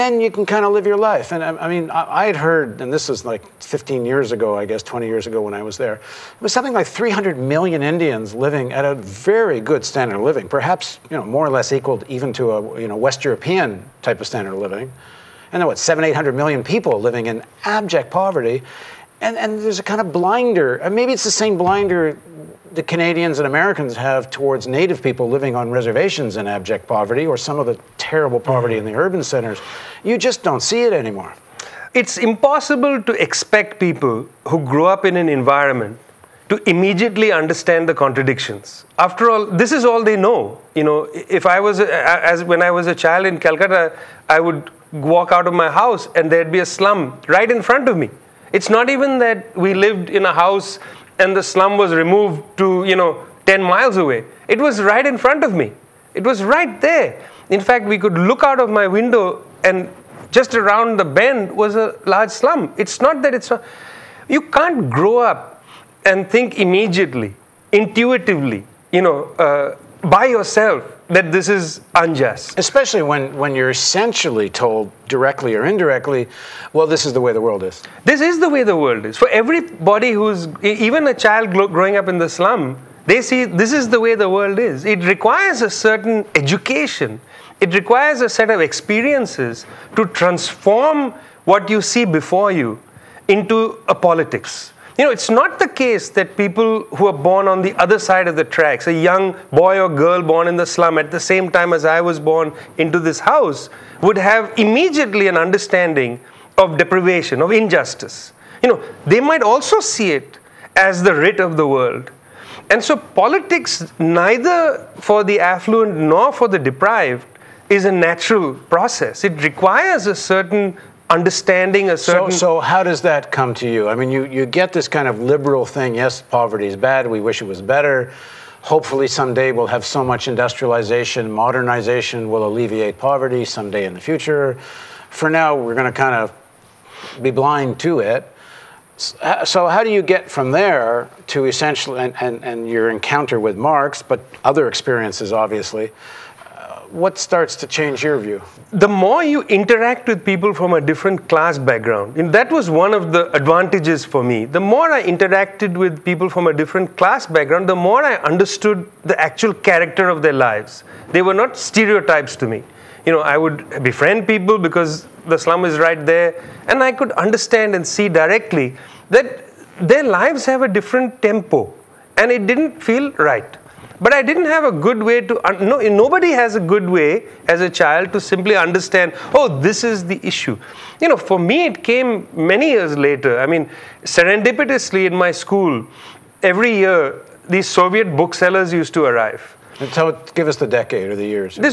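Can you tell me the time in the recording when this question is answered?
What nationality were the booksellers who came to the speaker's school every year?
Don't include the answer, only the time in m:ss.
3:07.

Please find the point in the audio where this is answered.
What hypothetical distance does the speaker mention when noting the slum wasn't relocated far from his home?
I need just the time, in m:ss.
0:53.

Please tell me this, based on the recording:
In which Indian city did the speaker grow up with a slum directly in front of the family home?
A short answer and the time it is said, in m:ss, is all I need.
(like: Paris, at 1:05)
Calcutta, at 0:43.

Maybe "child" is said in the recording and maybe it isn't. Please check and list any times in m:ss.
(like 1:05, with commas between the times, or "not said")
0:42, 1:21, 2:57.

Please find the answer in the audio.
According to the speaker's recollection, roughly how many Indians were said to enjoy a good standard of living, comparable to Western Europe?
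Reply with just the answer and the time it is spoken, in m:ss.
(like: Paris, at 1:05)
300 million, at 0:06.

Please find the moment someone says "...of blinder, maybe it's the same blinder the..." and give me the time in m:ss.
0:20.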